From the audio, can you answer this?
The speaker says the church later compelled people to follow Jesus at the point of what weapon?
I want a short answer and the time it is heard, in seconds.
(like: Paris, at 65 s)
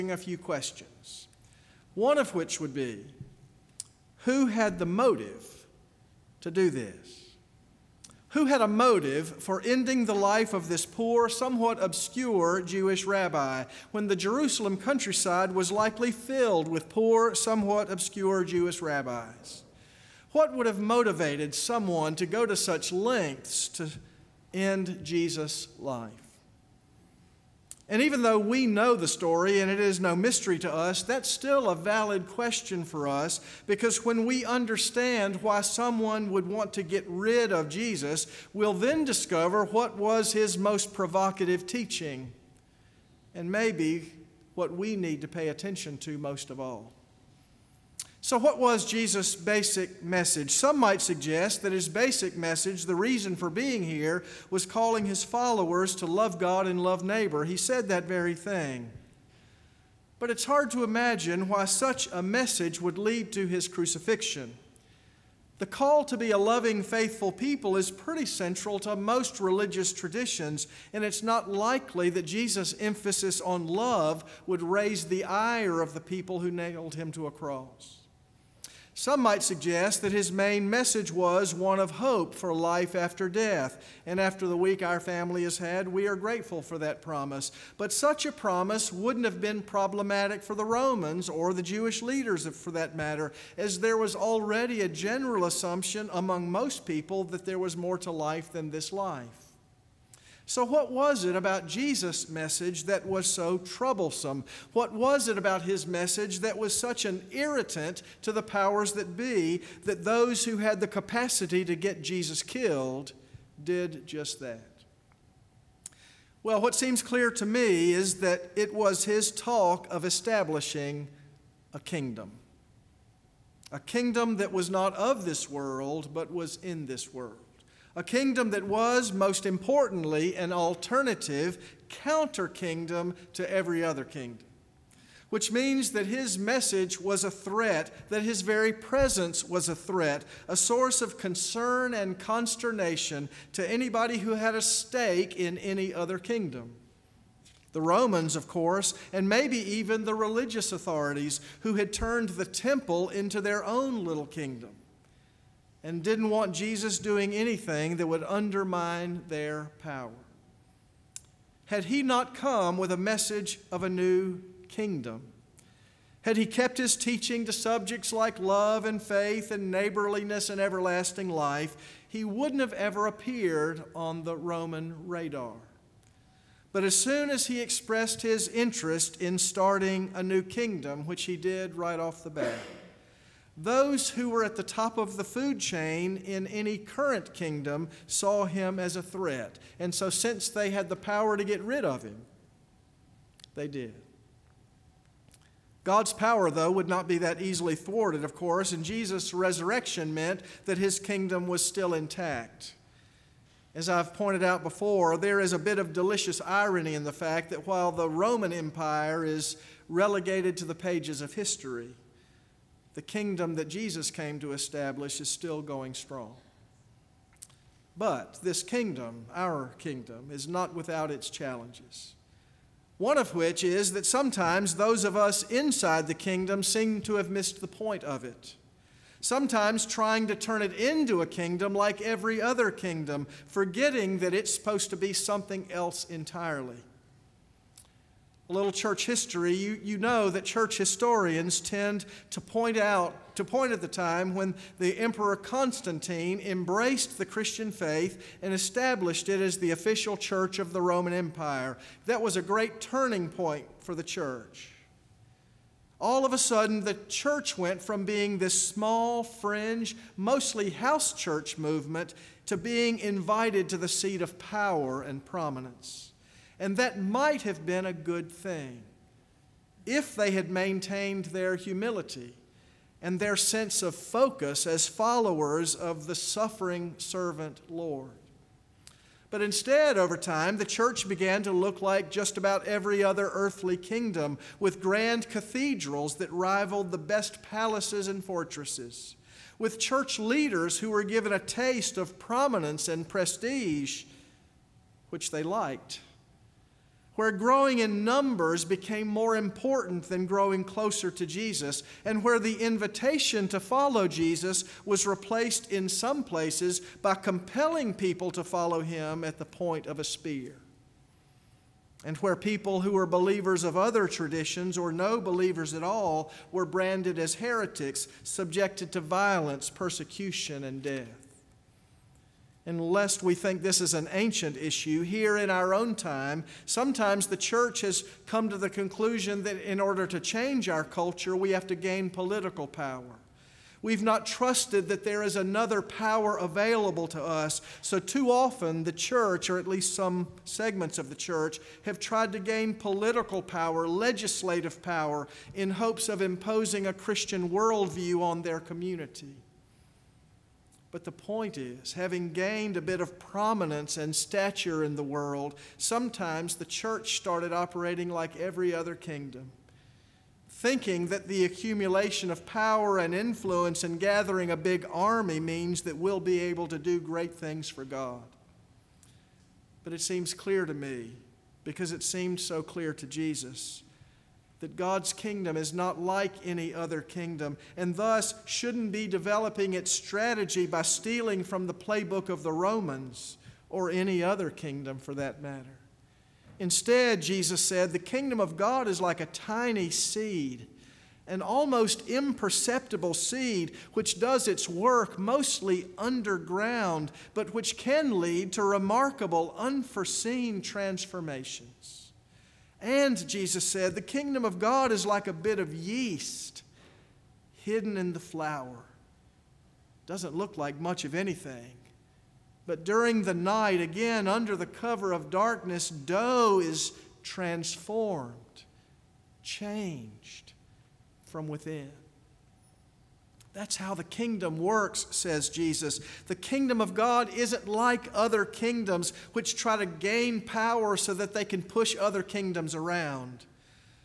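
a spear, at 309 s.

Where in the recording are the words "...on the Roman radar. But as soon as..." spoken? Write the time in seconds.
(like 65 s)
173 s.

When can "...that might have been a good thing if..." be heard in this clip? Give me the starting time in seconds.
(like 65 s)
266 s.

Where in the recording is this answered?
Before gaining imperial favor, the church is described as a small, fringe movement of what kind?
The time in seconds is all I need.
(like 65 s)
260 s.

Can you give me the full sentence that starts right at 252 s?
That was a great turning point for the church.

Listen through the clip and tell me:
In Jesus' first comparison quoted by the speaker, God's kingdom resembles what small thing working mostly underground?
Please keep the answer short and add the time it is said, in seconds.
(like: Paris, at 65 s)
a tiny seed, at 389 s.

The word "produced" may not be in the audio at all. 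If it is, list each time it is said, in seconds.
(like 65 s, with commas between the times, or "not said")
not said.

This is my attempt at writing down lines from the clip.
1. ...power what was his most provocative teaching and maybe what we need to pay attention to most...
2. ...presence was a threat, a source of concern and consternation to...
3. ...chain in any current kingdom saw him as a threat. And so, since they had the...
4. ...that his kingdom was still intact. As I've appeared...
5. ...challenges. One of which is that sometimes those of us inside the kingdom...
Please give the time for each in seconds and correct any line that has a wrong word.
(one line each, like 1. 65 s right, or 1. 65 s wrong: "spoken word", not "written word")
1. 39 s wrong: "discover", not "power"
2. 138 s right
3. 185 s right
4. 200 s wrong: "pointed", not "appeared"
5. 221 s right.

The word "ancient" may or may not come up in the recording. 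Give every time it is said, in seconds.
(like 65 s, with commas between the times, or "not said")
324 s.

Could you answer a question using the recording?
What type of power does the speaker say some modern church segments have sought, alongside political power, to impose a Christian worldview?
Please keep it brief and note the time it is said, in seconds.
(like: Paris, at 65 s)
legislative power, at 343 s.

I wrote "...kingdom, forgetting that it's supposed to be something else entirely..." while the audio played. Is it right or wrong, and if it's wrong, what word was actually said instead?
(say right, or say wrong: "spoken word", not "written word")
right.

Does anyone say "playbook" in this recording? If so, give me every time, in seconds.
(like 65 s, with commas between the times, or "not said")
381 s.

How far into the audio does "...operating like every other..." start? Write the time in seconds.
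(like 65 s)
357 s.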